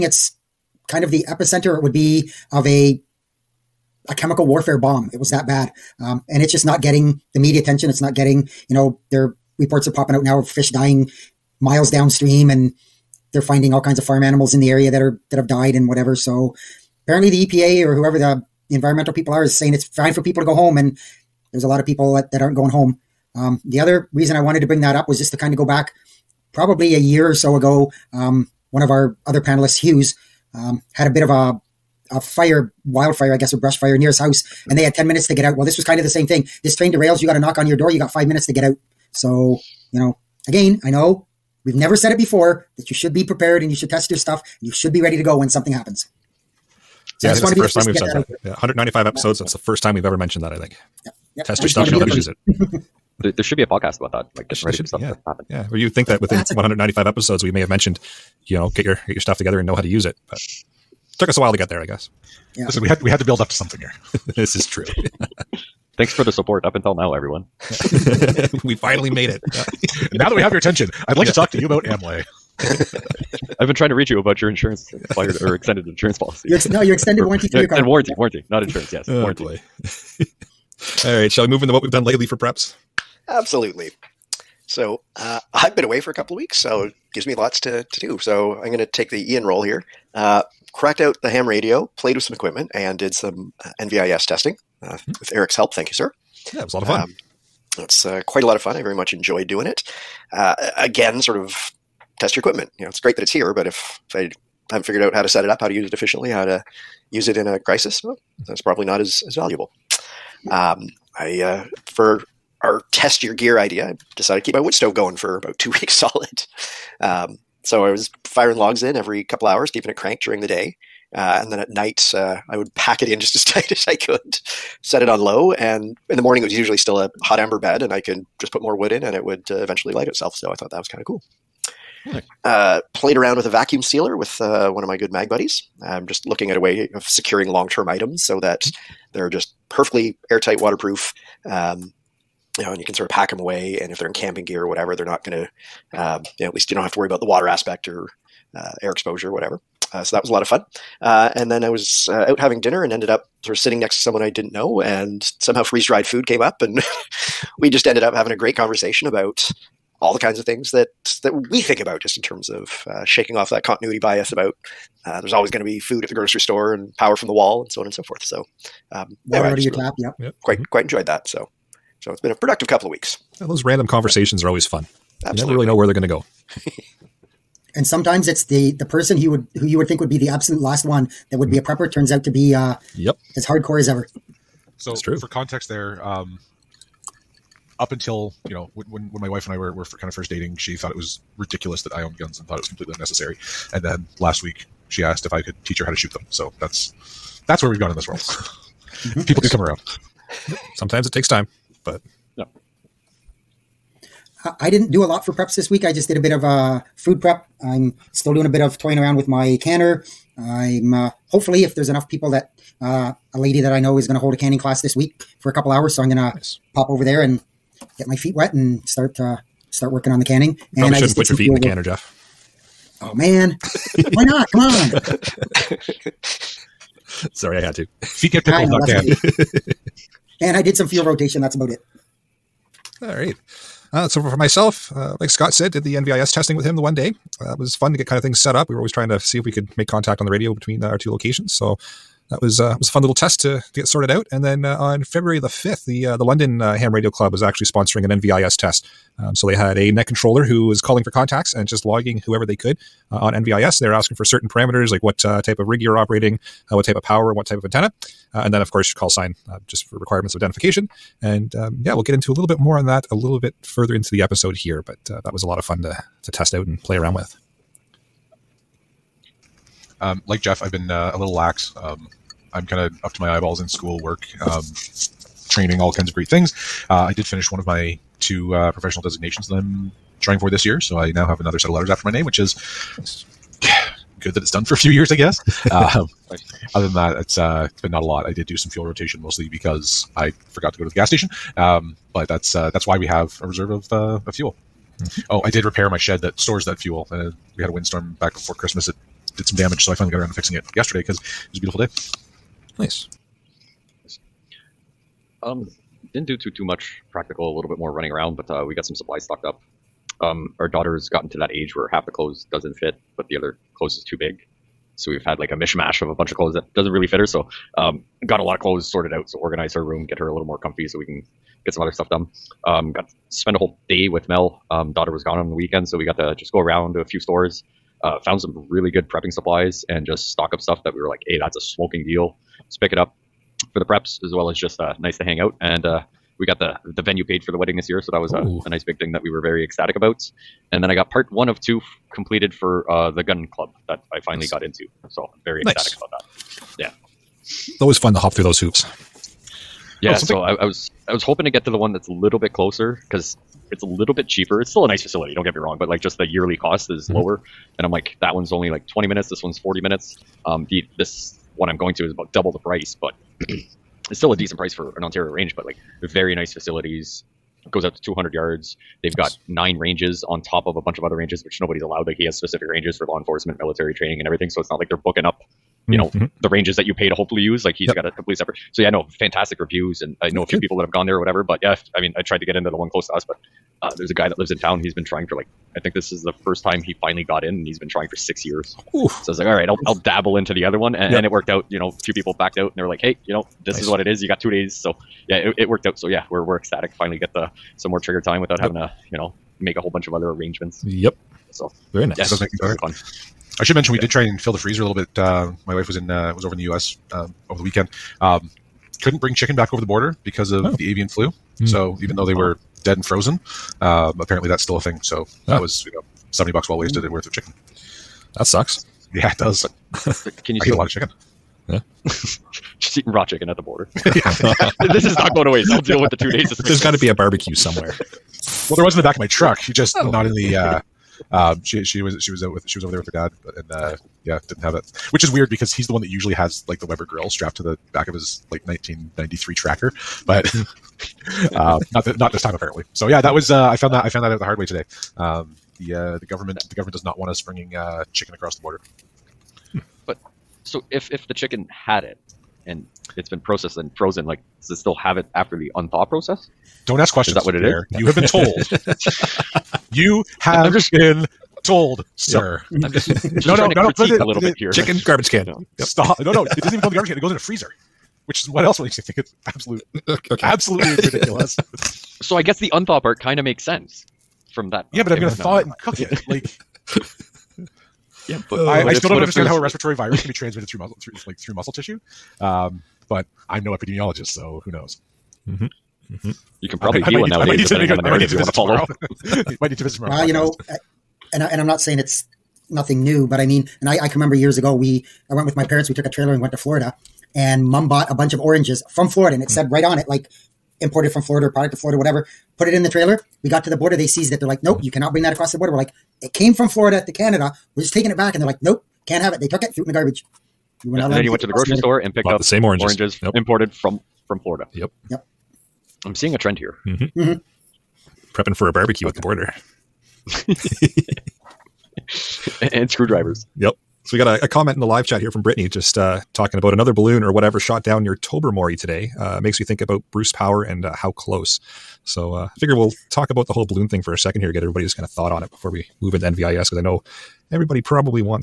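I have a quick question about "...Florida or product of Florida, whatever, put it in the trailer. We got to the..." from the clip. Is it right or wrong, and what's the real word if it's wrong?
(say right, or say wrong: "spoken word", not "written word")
right.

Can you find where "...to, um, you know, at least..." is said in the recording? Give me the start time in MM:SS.
02:25.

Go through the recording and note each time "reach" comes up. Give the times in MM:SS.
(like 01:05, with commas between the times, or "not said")
01:13.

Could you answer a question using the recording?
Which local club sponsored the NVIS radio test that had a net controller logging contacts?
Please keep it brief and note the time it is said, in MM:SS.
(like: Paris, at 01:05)
London Ham Radio Club, at 04:06.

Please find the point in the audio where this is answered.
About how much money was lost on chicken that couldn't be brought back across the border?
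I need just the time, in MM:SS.
06:56.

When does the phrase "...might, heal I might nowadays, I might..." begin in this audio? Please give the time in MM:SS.
08:07.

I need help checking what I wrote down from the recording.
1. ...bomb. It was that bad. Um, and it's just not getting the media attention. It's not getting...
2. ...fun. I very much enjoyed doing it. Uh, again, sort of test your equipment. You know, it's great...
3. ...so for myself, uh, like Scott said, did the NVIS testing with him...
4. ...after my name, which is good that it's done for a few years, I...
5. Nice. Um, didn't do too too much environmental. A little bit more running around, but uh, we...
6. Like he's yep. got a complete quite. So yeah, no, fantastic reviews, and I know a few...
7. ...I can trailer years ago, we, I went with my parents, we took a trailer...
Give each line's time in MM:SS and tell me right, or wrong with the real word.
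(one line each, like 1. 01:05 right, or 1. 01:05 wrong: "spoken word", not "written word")
1. 00:04 right
2. 01:38 right
3. 03:54 right
4. 04:41 right
5. 05:02 wrong: "practical", not "environmental"
6. 06:17 wrong: "separate", not "quite"
7. 08:14 wrong: "remember", not "trailer".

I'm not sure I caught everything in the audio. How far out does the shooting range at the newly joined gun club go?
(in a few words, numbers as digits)
200 yards.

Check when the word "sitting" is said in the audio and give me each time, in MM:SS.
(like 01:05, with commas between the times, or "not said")
02:33.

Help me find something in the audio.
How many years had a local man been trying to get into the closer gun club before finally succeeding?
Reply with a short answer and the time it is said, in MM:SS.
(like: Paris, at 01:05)
six years, at 06:28.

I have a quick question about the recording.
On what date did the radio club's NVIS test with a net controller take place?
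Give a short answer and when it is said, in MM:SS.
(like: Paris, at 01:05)
February 5, at 04:05.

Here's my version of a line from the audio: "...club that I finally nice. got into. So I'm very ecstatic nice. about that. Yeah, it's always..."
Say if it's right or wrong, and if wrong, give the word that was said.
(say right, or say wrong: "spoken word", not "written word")
right.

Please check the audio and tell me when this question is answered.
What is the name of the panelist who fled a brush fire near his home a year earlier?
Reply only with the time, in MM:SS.
00:29.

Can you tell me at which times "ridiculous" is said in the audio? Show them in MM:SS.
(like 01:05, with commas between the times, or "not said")
03:11, 07:51.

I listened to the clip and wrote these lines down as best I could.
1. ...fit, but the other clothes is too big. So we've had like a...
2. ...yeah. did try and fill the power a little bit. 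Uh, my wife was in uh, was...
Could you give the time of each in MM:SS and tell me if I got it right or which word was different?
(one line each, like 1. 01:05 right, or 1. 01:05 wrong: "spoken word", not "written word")
1. 05:12 right
2. 06:43 wrong: "freezer", not "power".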